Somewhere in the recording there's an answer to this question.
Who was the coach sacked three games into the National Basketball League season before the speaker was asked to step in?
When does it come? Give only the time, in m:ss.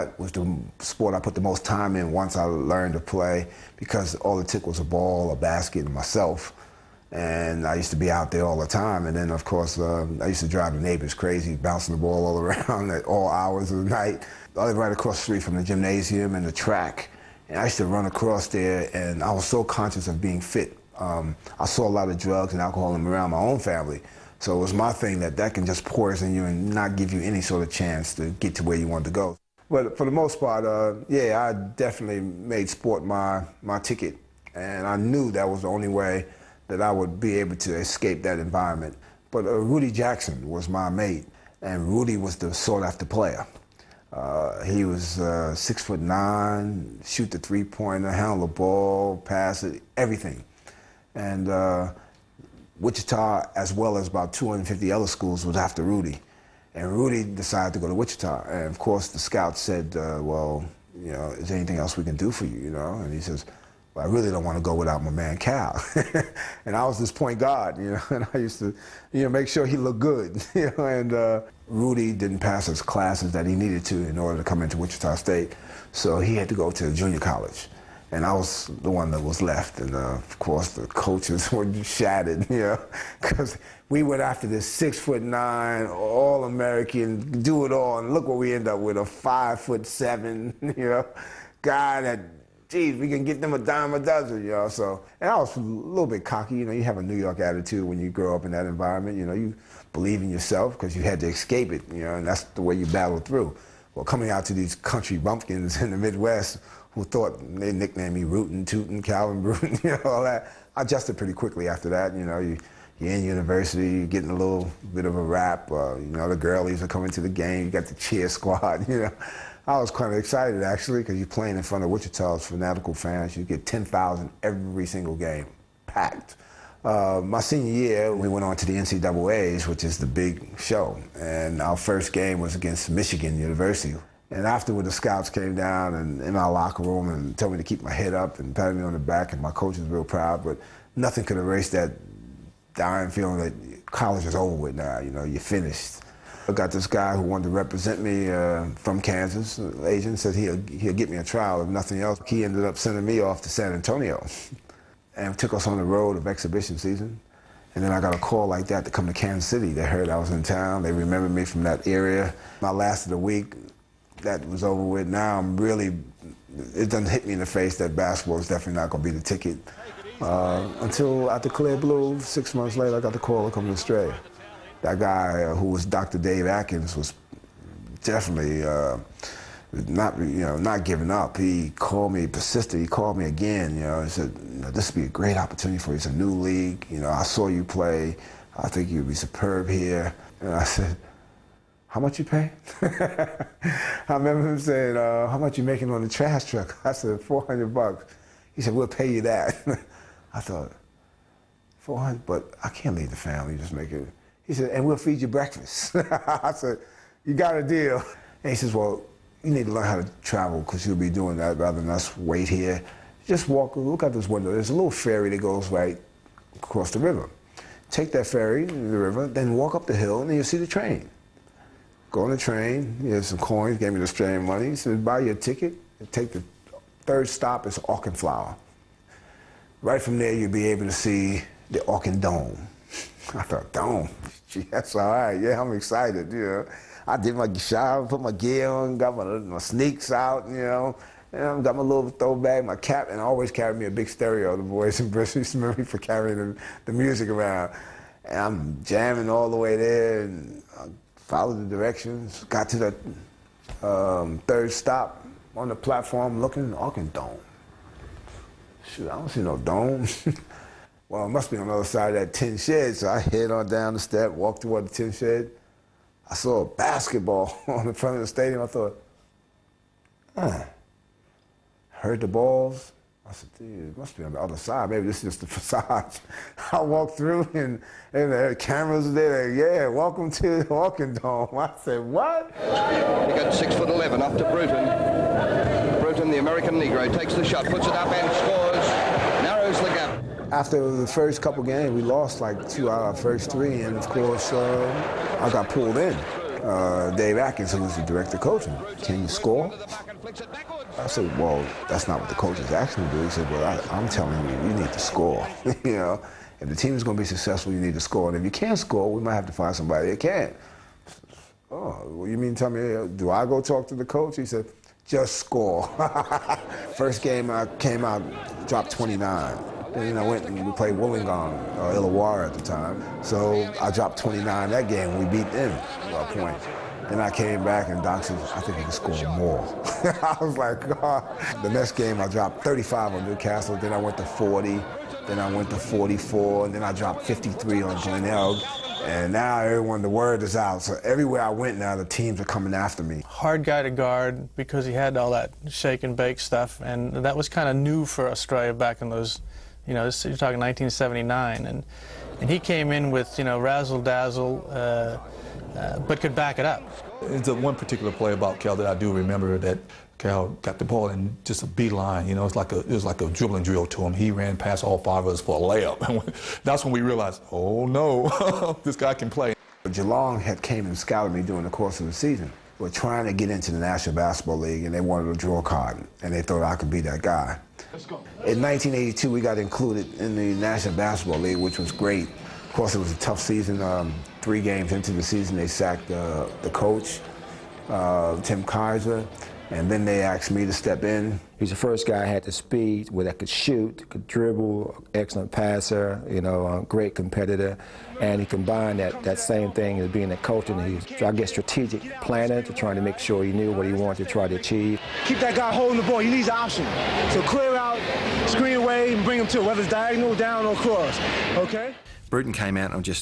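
6:28.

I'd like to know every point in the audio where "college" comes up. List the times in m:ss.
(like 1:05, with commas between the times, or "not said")
1:17, 2:23.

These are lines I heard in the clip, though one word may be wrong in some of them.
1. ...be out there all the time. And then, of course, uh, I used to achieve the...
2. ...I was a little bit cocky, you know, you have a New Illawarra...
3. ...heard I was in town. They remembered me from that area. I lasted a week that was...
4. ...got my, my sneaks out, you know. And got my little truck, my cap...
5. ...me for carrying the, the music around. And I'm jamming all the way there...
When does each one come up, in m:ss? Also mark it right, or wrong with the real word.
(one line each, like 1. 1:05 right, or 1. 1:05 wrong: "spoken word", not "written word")
1. 0:07 wrong: "drive", not "achieve"
2. 1:35 wrong: "York", not "Illawarra"
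3. 2:39 right
4. 3:58 wrong: "throwback", not "truck"
5. 4:05 right.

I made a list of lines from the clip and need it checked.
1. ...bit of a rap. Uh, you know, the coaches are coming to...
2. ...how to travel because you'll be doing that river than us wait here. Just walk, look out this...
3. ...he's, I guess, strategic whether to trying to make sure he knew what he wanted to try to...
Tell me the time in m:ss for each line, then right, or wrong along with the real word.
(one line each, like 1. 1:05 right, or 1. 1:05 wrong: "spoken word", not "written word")
1. 1:54 wrong: "girlies", not "coaches"
2. 3:29 wrong: "rather", not "river"
3. 6:41 wrong: "planner", not "whether".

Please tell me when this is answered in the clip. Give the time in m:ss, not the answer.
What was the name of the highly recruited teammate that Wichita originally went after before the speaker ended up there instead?
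0:39.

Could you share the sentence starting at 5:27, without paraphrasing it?
Then I came back and Doc I think he can score more.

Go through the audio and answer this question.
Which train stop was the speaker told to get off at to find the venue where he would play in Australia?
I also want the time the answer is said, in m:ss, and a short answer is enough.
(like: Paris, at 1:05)
Auchenflower, at 3:47.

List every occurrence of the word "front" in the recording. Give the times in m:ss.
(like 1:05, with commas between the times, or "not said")
2:01, 4:27.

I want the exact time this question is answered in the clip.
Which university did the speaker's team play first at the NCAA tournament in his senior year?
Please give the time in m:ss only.
2:12.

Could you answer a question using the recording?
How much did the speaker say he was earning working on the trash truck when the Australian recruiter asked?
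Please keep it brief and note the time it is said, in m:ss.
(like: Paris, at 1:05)
400 bucks, at 3:17.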